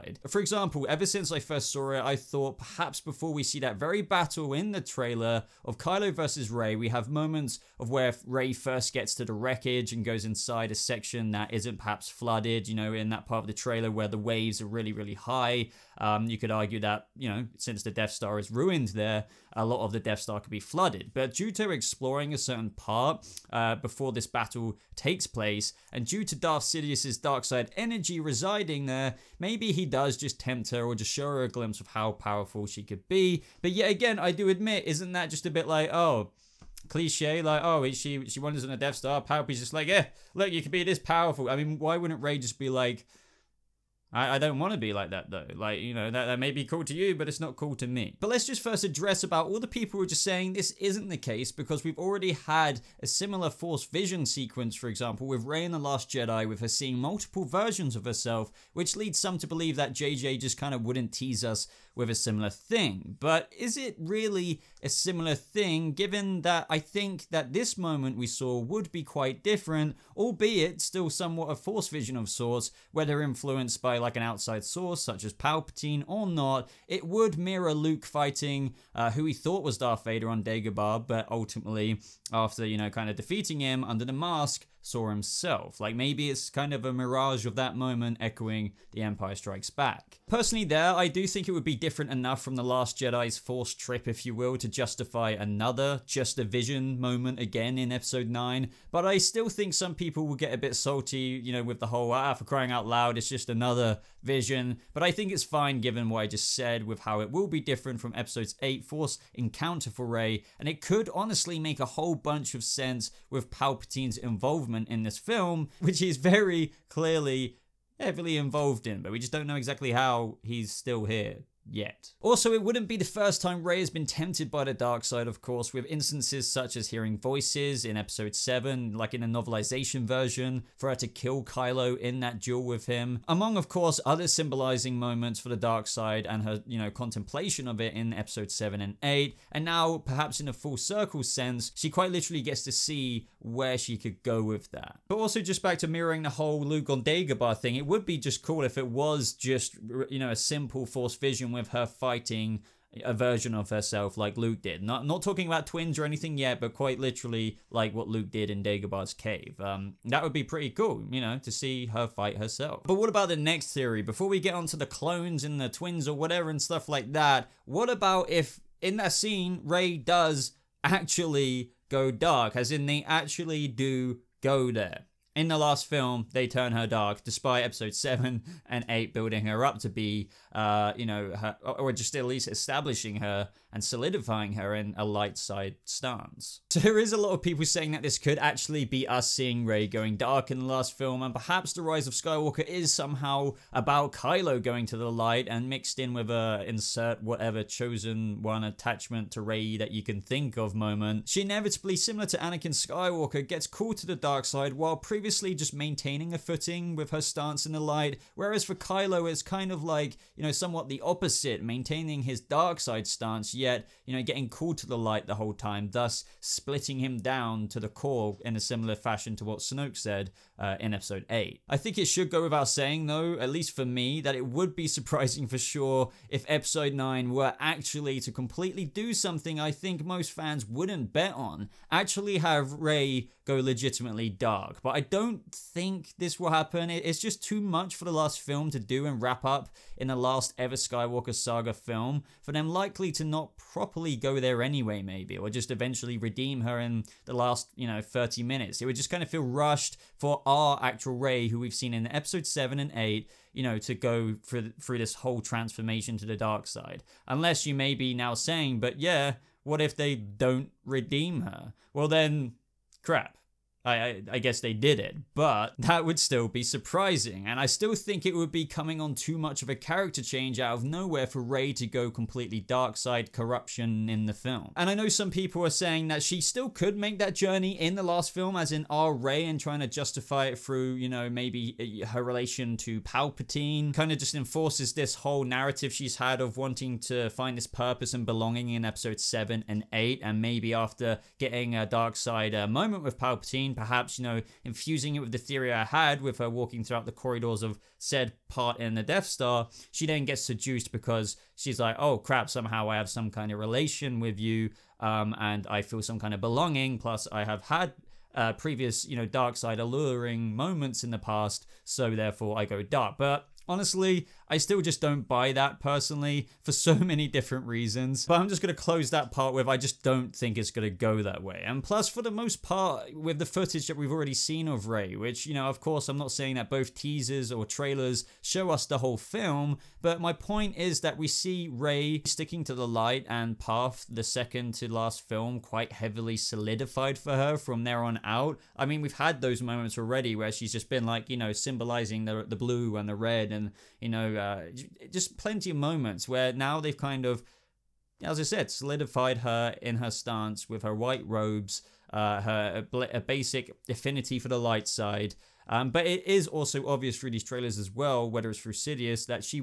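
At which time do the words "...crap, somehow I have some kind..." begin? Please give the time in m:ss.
5:02.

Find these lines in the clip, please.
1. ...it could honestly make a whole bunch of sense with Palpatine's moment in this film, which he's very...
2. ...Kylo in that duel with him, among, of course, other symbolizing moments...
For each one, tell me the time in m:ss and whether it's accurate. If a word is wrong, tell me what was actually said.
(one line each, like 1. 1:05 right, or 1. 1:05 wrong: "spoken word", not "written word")
1. 1:50 wrong: "involvement", not "moment"
2. 2:11 right.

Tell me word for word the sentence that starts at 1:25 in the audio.
Like maybe it's kind of a mirage of that moment echoing The Empire Strikes Back.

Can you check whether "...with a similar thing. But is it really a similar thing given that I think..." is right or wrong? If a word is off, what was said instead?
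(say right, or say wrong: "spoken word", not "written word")
right.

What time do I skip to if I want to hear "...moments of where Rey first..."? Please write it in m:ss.
0:07.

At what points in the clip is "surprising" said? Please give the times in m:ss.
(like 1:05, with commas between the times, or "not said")
3:44, 4:26.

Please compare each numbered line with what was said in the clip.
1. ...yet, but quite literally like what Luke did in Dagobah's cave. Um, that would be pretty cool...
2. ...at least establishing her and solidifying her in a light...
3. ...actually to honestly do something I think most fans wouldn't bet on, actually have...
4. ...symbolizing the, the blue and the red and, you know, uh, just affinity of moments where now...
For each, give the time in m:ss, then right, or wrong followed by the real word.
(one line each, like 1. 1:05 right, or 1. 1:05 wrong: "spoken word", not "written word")
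1. 2:36 right
2. 3:02 right
3. 3:47 wrong: "completely", not "honestly"
4. 5:41 wrong: "plenty", not "affinity".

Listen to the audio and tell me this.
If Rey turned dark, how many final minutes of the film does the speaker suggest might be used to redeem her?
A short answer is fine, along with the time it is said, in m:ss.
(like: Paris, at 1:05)
30, at 4:08.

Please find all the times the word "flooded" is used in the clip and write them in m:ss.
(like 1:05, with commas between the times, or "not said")
0:12, 0:20.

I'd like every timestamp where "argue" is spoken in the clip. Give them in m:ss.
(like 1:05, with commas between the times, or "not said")
0:16.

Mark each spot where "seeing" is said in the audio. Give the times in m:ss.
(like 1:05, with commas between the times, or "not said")
0:56, 3:09.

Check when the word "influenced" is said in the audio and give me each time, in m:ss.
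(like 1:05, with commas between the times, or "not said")
1:13.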